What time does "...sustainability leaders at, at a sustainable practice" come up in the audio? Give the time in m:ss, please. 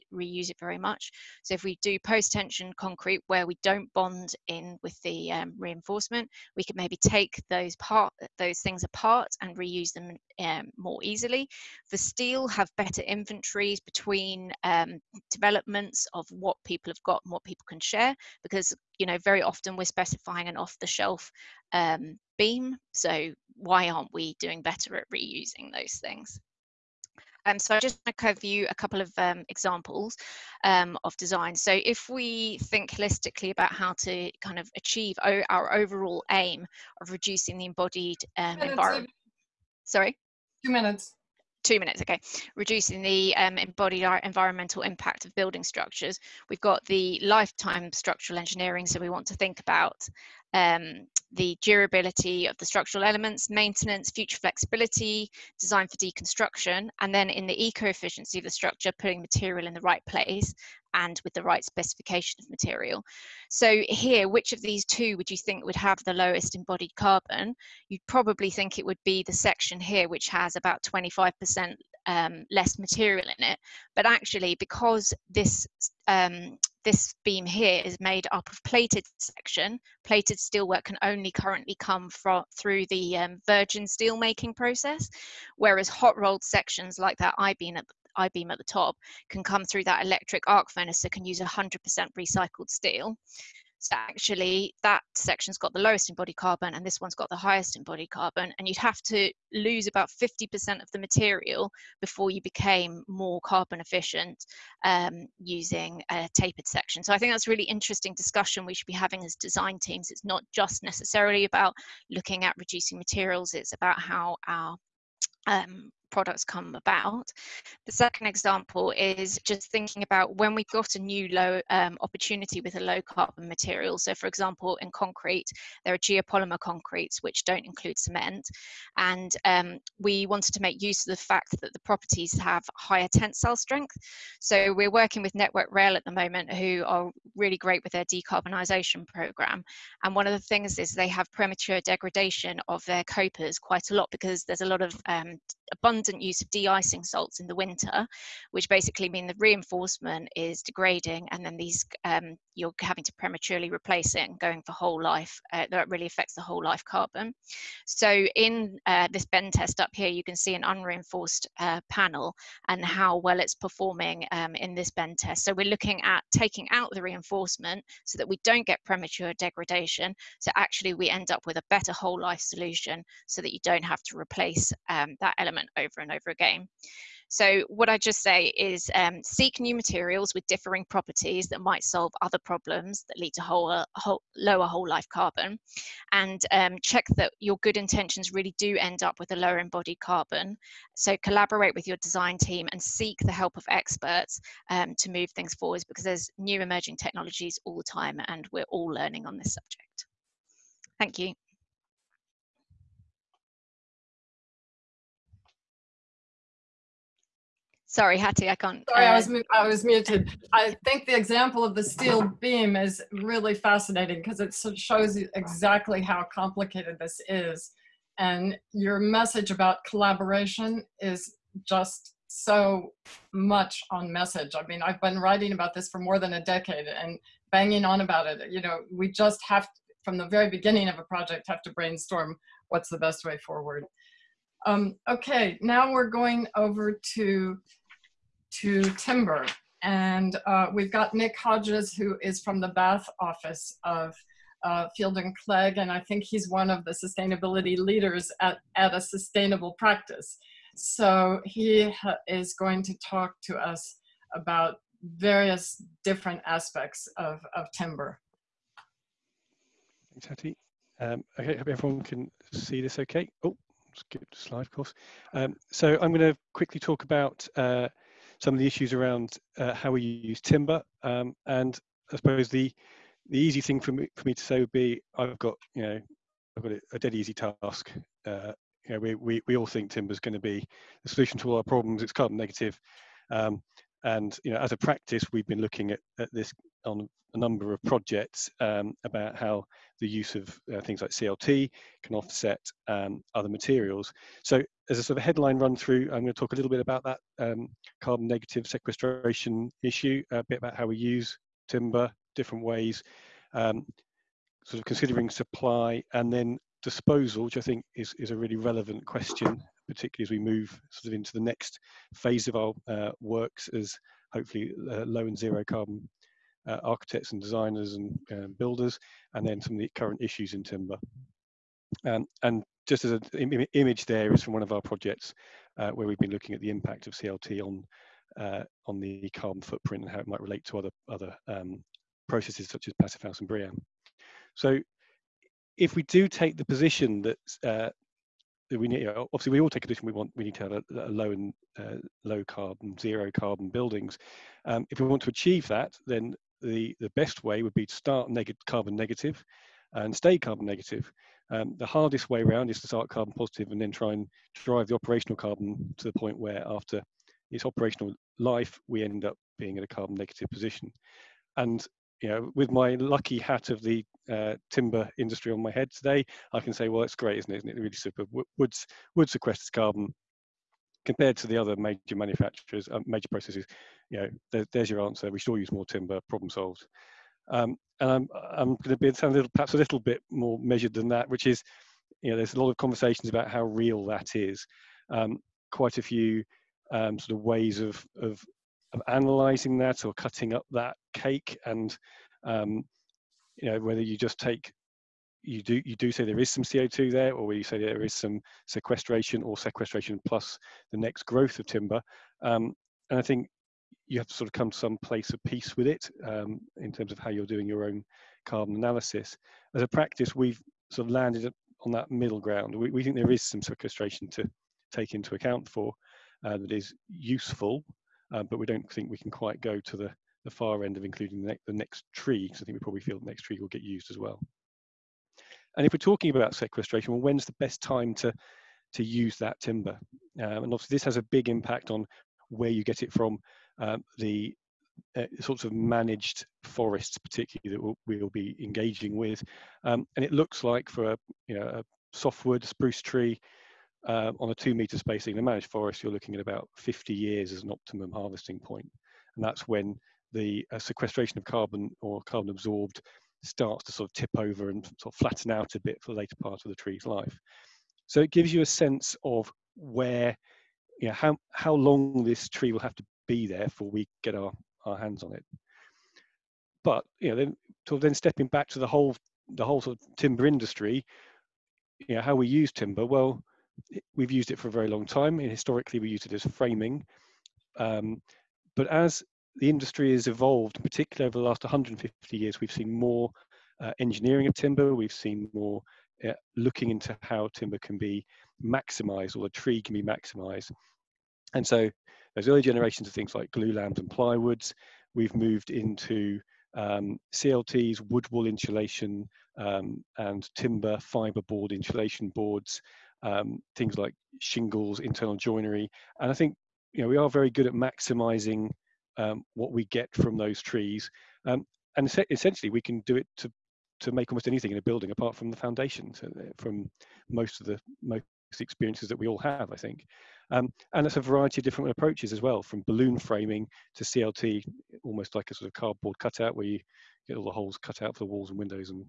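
4:06.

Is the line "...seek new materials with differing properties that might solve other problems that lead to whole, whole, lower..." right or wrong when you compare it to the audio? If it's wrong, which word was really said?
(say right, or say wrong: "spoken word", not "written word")
right.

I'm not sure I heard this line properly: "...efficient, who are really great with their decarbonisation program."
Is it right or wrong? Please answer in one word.
wrong.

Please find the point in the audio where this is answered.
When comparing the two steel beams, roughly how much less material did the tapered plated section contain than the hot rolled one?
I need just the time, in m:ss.
1:10.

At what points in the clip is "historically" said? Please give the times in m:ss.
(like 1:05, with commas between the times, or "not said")
7:55.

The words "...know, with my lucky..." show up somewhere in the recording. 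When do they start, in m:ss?
6:02.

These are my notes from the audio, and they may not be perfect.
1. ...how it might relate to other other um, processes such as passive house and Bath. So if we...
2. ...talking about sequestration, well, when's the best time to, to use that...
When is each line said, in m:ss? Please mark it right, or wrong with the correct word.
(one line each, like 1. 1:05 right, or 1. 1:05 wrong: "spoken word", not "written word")
1. 5:30 wrong: "BREEAM", not "Bath"
2. 7:05 right.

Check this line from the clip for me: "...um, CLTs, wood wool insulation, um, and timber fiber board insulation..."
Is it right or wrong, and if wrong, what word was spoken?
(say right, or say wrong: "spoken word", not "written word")
right.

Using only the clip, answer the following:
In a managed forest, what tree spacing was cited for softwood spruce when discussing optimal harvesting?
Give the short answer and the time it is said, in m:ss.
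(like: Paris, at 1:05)
2 meter spacing, at 7:24.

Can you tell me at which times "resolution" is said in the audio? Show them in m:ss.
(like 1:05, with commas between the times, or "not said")
not said.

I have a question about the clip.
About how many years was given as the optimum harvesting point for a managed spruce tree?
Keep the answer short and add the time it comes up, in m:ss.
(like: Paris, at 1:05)
50 years, at 7:26.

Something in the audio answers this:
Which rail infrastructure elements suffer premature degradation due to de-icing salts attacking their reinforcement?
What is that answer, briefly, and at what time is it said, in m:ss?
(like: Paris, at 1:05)
copers, at 2:23.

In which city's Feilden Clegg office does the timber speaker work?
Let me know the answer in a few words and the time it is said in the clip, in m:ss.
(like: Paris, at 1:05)
Bath, at 4:02.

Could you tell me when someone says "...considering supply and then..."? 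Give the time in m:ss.
5:04.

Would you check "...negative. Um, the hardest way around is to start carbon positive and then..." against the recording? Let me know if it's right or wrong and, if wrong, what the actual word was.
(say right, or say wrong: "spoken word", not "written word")
right.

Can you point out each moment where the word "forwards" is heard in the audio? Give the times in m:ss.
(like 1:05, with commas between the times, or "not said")
3:15, 3:53.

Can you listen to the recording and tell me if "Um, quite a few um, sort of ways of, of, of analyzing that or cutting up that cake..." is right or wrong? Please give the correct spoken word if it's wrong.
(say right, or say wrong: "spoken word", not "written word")
right.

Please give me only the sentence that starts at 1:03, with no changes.
So here, which of these two would you think would have the lowest embodied carbon?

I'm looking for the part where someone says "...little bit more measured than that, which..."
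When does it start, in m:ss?
6:19.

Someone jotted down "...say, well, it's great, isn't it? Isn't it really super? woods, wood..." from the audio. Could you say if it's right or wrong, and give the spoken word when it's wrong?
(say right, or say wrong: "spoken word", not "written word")
right.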